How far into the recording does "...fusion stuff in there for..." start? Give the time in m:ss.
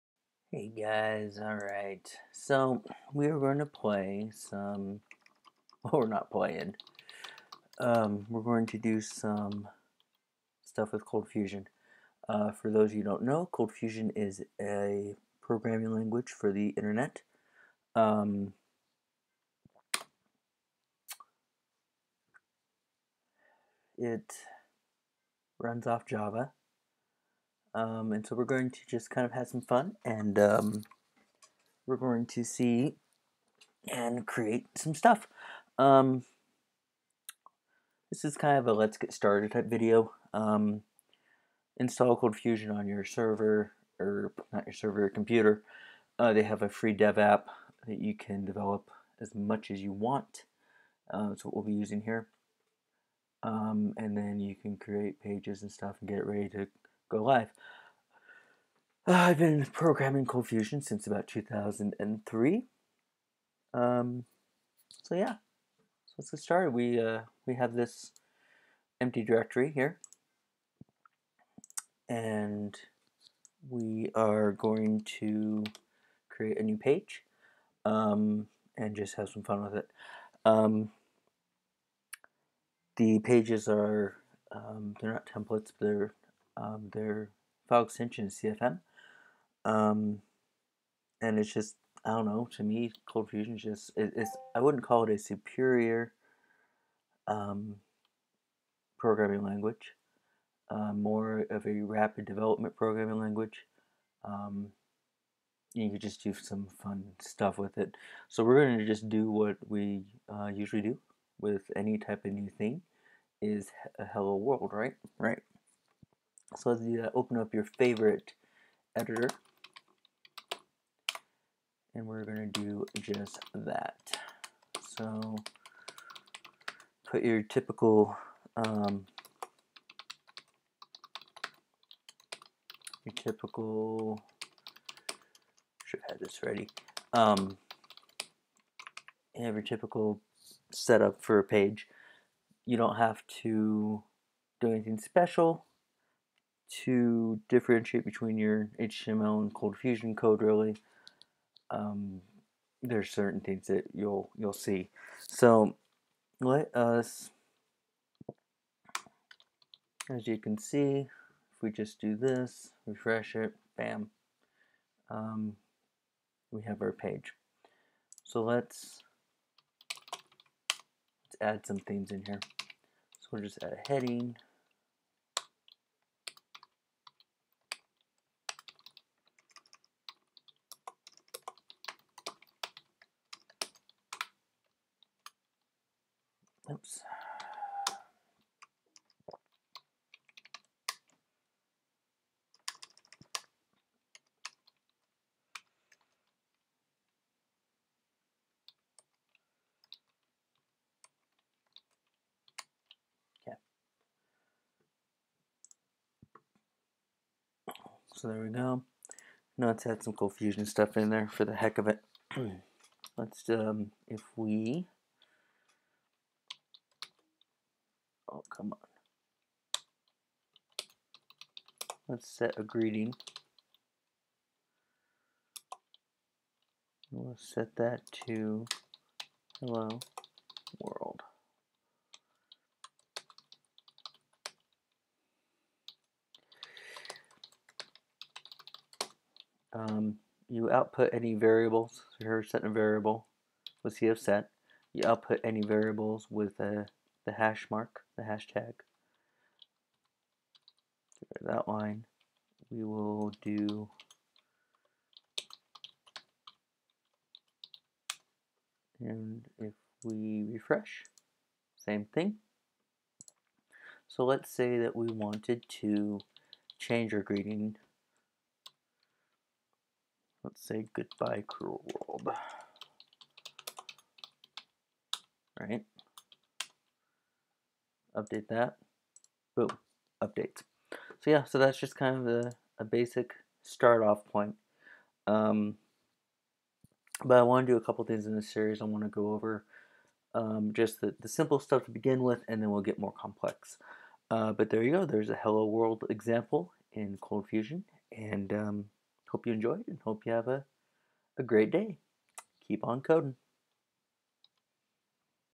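3:30.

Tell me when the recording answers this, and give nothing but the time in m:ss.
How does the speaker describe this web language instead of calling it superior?
1:41.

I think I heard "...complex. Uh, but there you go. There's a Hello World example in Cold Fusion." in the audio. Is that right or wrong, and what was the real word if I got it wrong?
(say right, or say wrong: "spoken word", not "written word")
right.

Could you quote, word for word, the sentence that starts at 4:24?
So let's say that we wanted to change our greeting.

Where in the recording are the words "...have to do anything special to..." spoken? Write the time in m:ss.
2:22.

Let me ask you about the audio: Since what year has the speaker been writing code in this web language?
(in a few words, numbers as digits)
2003.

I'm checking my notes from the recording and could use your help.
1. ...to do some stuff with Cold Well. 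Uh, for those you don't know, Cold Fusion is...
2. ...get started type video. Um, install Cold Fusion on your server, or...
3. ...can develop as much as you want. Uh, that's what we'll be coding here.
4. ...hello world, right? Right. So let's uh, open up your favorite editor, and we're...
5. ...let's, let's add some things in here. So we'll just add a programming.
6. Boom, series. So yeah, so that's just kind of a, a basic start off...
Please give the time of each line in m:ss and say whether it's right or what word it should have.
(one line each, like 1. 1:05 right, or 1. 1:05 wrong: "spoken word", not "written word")
1. 0:08 wrong: "Fusion", not "Well"
2. 0:38 right
3. 0:48 wrong: "using", not "coding"
4. 1:54 right
5. 2:48 wrong: "heading", not "programming"
6. 4:39 wrong: "updates", not "series".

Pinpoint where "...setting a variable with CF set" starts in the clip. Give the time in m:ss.
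4:02.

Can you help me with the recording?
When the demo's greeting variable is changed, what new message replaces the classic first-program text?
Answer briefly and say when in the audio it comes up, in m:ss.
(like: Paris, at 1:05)
goodbye cruel world, at 4:30.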